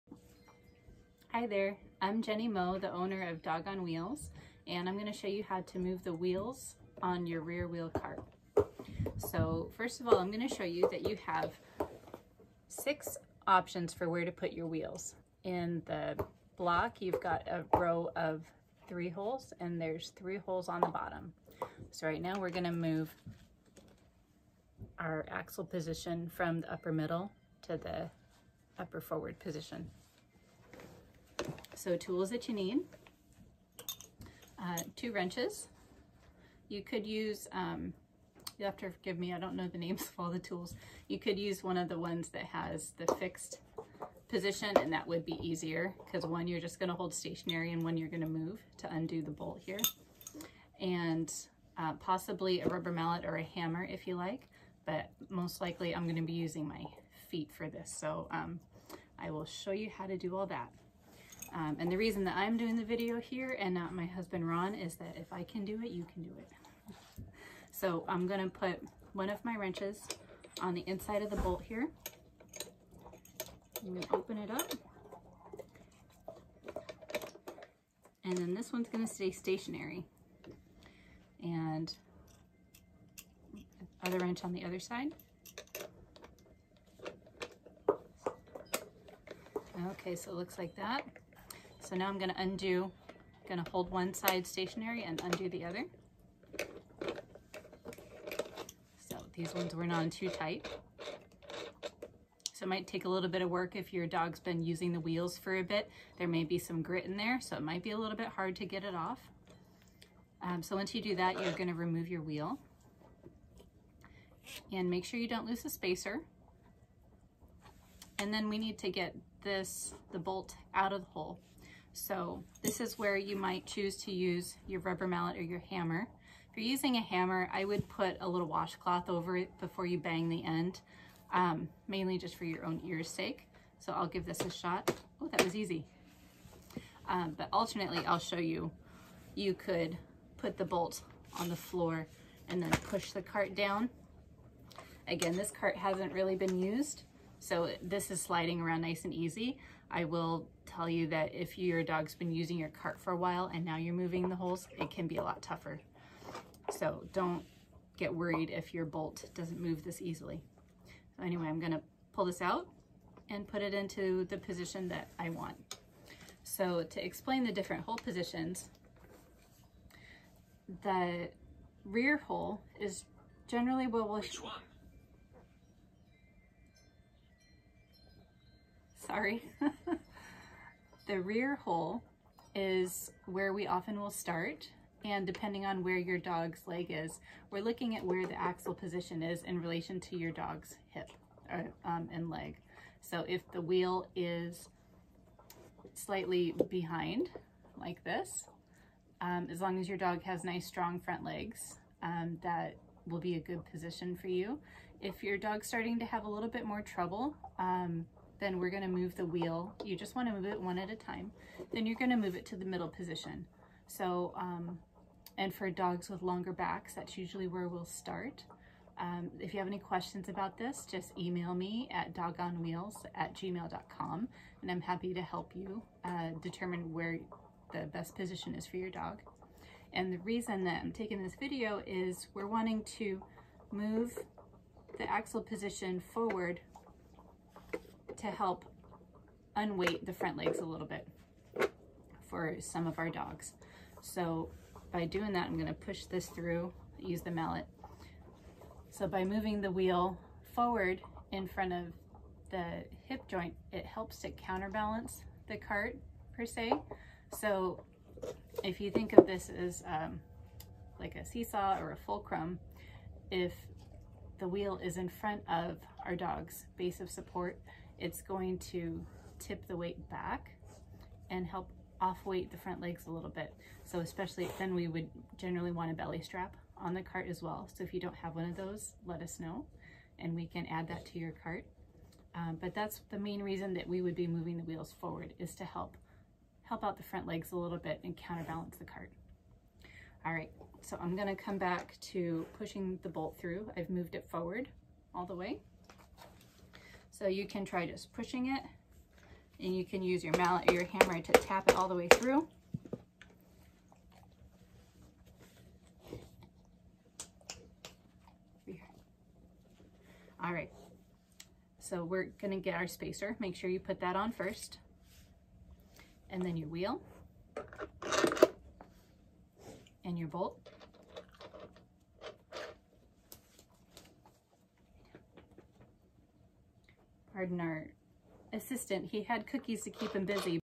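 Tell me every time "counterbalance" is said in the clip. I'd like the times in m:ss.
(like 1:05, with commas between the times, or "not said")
4:14, 4:48.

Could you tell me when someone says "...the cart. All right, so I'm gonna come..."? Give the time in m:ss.
4:48.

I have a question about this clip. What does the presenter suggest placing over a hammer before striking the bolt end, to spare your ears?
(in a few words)
washcloth.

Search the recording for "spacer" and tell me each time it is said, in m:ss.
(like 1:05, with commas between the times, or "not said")
1:55, 5:12.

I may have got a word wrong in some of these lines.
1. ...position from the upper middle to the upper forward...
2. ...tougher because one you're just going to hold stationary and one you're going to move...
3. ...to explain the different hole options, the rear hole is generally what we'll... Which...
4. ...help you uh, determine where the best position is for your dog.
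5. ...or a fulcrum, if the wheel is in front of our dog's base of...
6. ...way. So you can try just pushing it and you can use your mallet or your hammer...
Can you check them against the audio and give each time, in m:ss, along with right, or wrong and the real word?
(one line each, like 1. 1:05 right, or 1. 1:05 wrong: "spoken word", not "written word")
1. 0:25 right
2. 0:45 wrong: "easier", not "tougher"
3. 2:46 wrong: "positions", not "options"
4. 3:45 right
5. 4:21 right
6. 4:55 right.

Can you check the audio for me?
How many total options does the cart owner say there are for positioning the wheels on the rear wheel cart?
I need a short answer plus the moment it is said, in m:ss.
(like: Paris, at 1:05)
6, at 0:12.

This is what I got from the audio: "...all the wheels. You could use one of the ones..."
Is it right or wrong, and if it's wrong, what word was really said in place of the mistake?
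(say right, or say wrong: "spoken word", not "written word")
wrong: "tools", not "wheels".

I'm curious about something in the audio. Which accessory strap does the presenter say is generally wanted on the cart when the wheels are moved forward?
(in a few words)
belly strap.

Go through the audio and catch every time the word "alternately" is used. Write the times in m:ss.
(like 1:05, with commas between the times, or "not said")
2:17.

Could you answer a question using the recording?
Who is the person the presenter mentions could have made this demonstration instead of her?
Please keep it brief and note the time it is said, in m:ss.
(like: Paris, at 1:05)
Ron, at 1:04.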